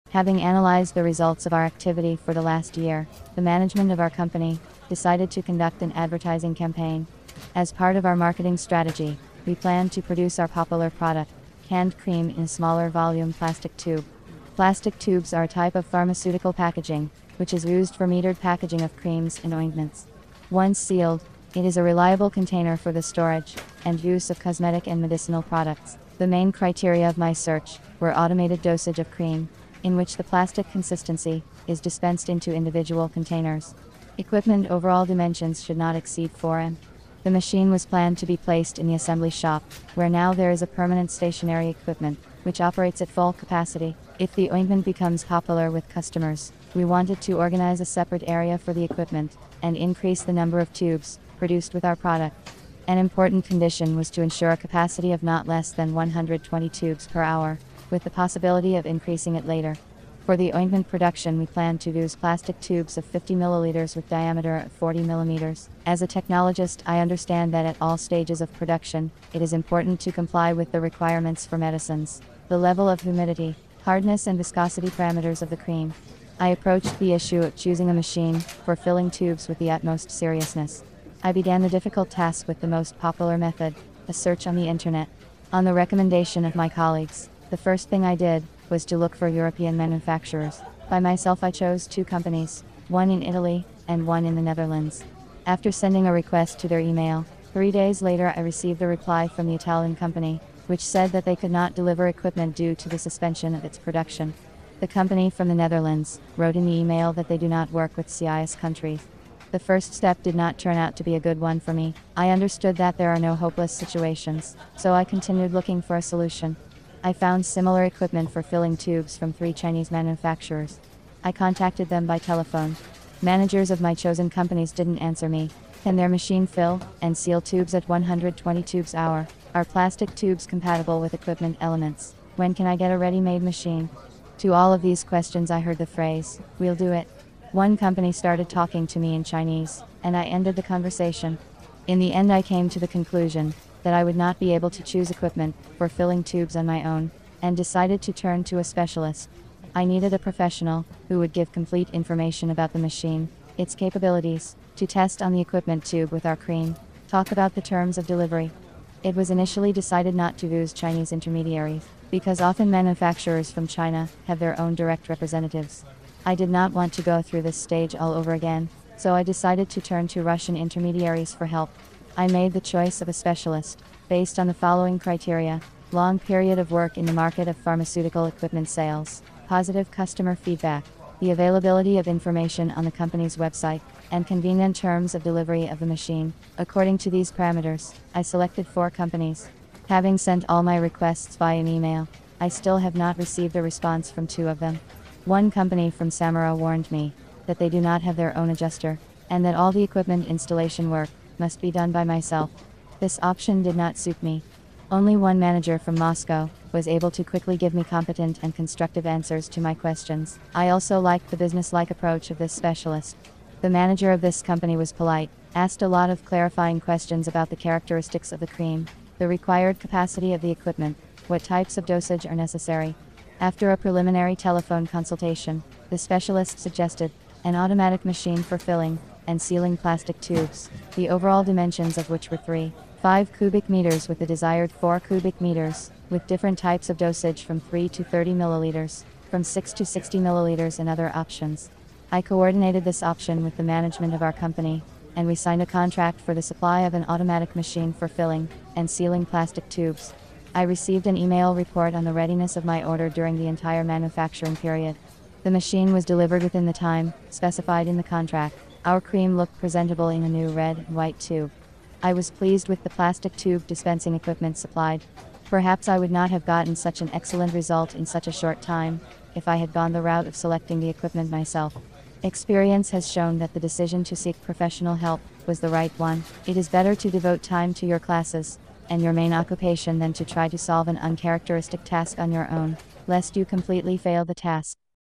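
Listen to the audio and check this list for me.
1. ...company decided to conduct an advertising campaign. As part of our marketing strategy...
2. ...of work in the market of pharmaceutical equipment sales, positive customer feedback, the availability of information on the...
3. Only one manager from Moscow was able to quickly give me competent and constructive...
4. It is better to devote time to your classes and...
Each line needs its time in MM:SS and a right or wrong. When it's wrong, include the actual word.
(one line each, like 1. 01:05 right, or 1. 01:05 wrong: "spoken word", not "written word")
1. 00:04 right
2. 02:56 right
3. 03:24 right
4. 04:36 right.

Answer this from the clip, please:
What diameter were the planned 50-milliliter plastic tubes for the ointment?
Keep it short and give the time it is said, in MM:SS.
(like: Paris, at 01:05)
40 millimeters, at 01:04.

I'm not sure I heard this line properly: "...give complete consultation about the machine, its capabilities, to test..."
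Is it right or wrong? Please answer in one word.
wrong.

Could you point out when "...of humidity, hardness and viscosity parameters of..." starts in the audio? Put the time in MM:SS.
01:12.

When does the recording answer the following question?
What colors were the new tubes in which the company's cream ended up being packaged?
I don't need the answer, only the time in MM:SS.
04:20.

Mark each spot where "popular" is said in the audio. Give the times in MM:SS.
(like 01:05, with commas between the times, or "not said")
00:10, 00:45, 01:22.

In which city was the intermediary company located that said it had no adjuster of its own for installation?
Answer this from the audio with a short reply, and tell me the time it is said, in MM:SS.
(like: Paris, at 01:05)
Samara, at 03:16.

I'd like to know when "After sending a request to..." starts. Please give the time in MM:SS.
01:35.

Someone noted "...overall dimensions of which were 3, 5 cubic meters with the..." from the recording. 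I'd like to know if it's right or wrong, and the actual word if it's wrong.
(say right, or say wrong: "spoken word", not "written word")
right.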